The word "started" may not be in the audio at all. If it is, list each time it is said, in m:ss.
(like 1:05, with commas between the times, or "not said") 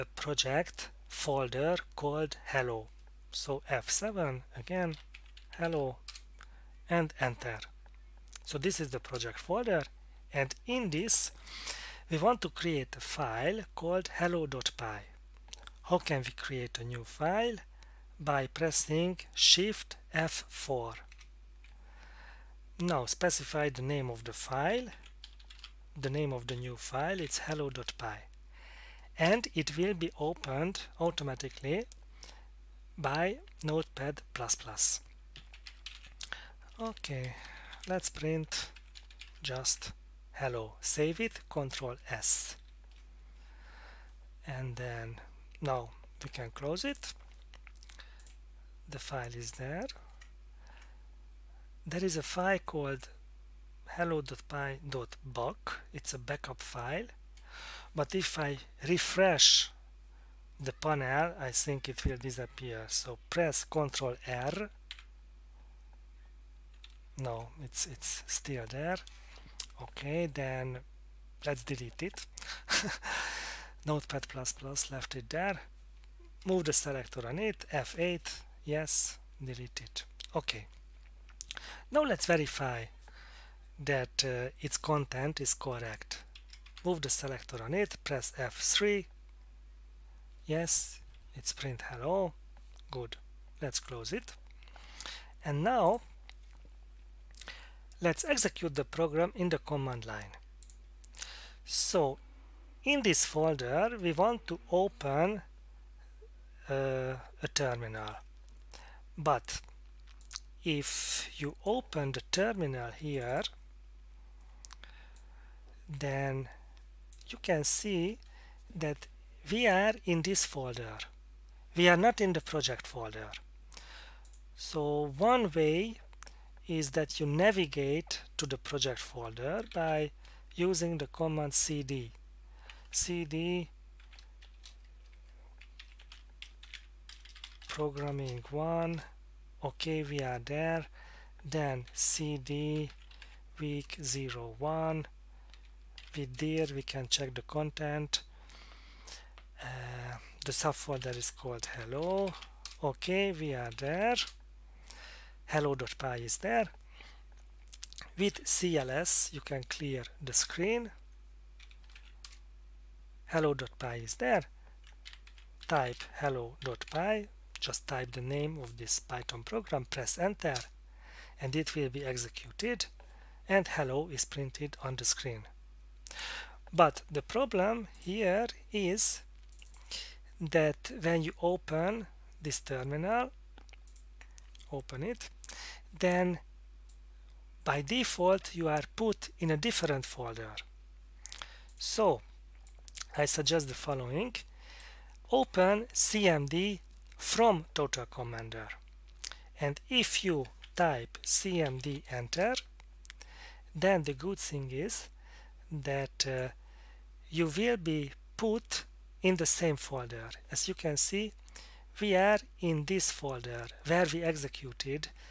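not said.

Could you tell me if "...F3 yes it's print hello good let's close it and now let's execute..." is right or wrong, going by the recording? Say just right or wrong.
right.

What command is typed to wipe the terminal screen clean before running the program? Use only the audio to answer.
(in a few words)
cls.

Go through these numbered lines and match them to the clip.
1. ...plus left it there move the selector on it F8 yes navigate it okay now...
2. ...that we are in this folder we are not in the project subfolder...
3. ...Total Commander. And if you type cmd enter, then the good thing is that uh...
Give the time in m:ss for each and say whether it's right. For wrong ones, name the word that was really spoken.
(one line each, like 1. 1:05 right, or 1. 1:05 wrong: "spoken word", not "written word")
1. 1:14 wrong: "delete", not "navigate"
2. 1:58 wrong: "folder", not "subfolder"
3. 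3:17 right.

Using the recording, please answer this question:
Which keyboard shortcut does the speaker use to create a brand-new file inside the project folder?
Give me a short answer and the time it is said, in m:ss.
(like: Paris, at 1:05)
Shift F4, at 0:19.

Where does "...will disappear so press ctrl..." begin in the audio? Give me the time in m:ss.
1:02.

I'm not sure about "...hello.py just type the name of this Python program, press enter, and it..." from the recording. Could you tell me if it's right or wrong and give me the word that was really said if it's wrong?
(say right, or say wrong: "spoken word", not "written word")
right.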